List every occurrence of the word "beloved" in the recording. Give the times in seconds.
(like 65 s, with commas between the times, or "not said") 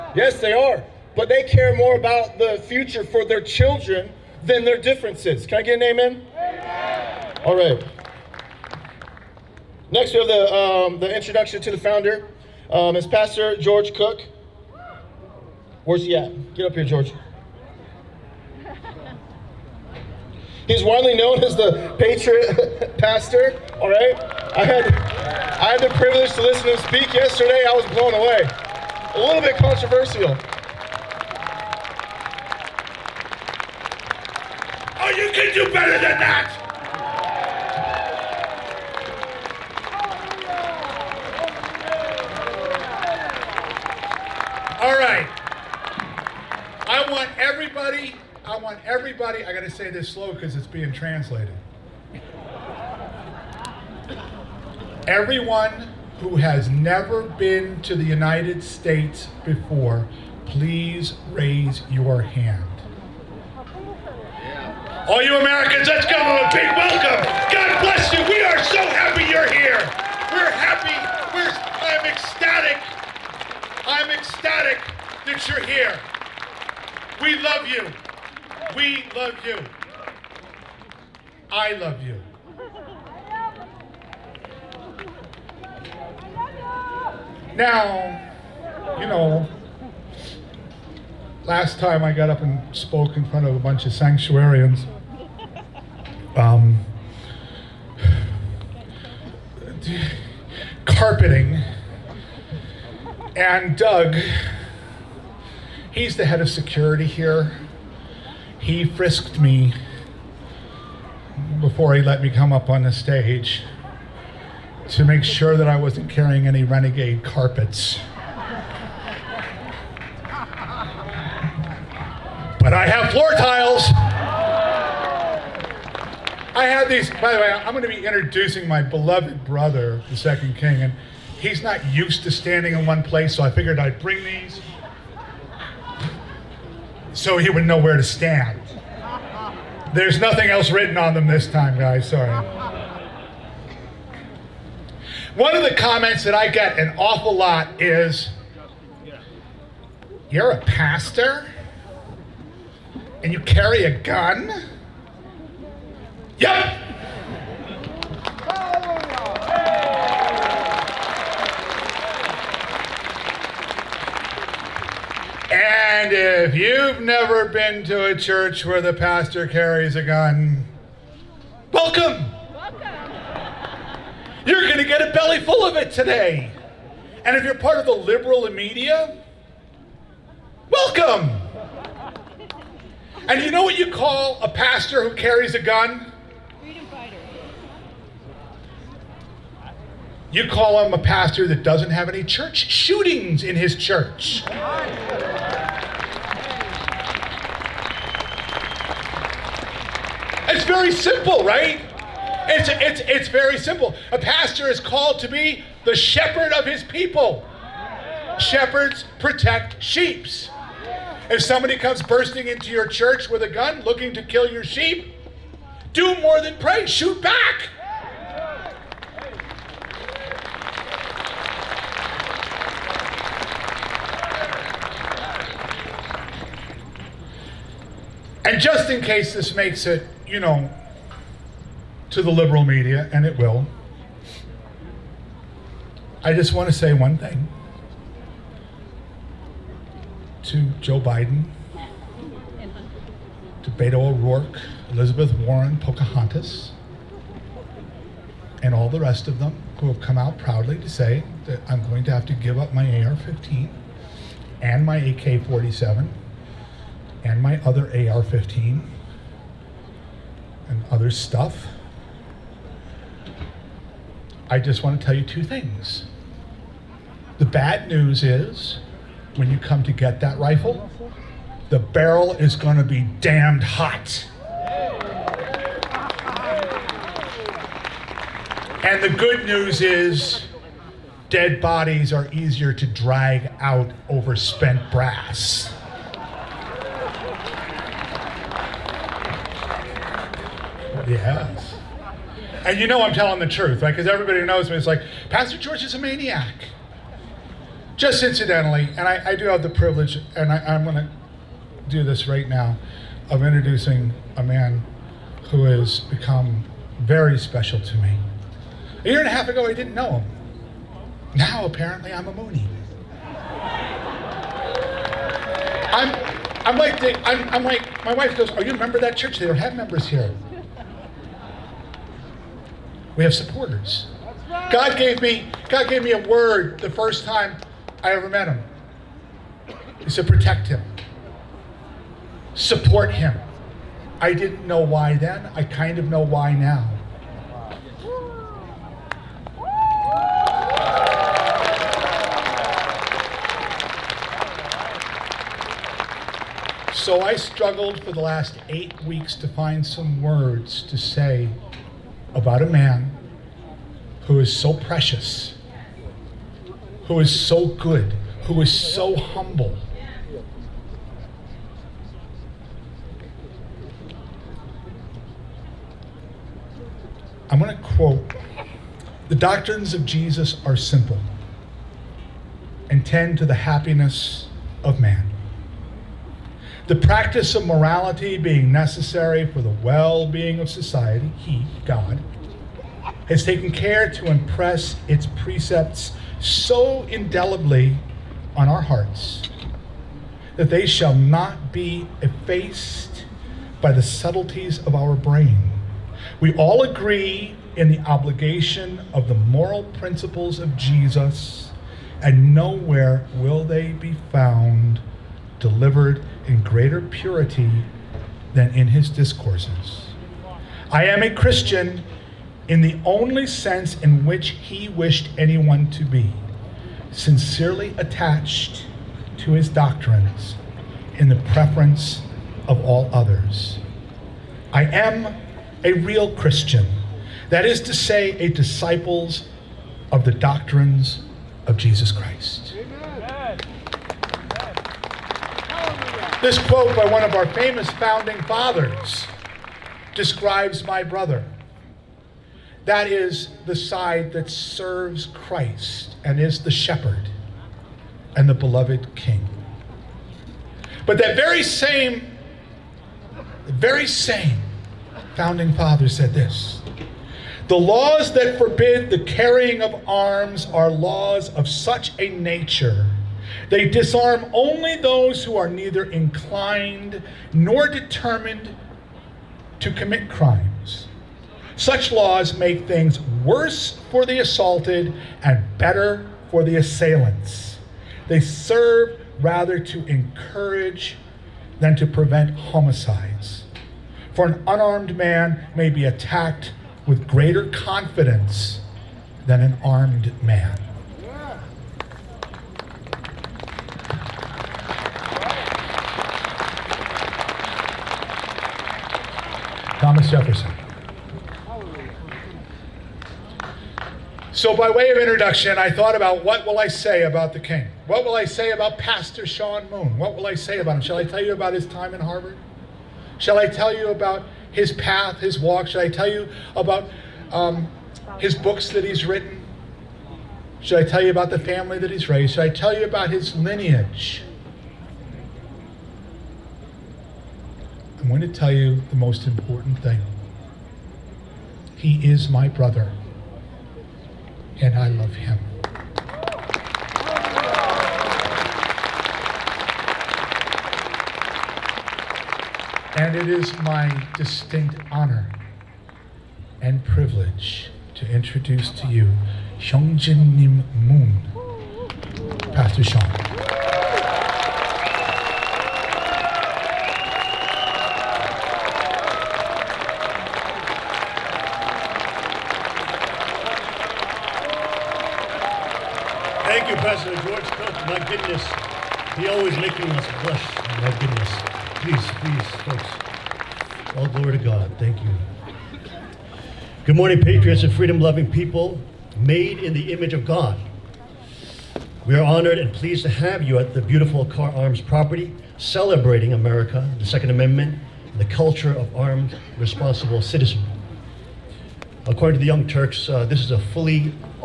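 128 s, 448 s.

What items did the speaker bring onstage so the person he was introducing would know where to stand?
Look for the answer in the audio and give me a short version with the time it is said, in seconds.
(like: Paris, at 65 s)
Floor tiles, at 123 s.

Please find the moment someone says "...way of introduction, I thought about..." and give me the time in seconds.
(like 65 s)
504 s.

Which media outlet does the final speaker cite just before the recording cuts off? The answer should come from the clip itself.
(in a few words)
The Young Turks.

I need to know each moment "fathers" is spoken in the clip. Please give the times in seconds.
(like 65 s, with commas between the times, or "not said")
438 s, 455 s.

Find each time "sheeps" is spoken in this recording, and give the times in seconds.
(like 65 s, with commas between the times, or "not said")
209 s, 214 s.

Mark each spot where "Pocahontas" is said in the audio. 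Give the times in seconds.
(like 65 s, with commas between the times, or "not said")
245 s.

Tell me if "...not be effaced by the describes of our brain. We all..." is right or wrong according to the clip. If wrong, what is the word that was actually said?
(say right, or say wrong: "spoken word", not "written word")
wrong: "subtleties", not "describes".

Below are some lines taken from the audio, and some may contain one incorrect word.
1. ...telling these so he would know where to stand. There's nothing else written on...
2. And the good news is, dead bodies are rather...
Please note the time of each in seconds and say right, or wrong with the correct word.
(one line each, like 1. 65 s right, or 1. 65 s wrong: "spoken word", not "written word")
1. 134 s wrong: "bring", not "telling"
2. 278 s wrong: "easier", not "rather".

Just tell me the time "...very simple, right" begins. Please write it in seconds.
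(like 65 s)
200 s.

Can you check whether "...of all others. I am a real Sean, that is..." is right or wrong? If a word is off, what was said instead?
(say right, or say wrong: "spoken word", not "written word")
wrong: "Christian", not "Sean".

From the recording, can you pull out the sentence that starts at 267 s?
The bad news is, when you come to get that rifle, the barrel is going to be damned hot.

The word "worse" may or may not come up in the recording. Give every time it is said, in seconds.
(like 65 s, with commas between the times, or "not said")
473 s.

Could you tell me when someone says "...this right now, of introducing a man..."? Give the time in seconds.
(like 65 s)
302 s.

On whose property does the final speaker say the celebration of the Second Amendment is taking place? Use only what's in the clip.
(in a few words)
Kahr Arms.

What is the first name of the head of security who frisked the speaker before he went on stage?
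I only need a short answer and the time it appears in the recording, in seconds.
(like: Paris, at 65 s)
Doug, at 103 s.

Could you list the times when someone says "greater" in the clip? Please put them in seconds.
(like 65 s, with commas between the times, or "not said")
406 s, 487 s.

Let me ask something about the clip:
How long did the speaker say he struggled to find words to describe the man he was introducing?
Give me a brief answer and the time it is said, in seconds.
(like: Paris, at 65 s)
8 weeks, at 348 s.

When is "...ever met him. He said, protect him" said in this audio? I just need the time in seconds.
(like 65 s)
328 s.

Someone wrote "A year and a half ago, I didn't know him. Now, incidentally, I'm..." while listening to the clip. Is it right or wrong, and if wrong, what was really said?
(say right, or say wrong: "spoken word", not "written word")
wrong: "apparently", not "incidentally".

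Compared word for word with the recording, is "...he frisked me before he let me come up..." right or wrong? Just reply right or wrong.
right.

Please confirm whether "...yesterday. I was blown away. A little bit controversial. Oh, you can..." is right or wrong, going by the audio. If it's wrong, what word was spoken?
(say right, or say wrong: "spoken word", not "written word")
right.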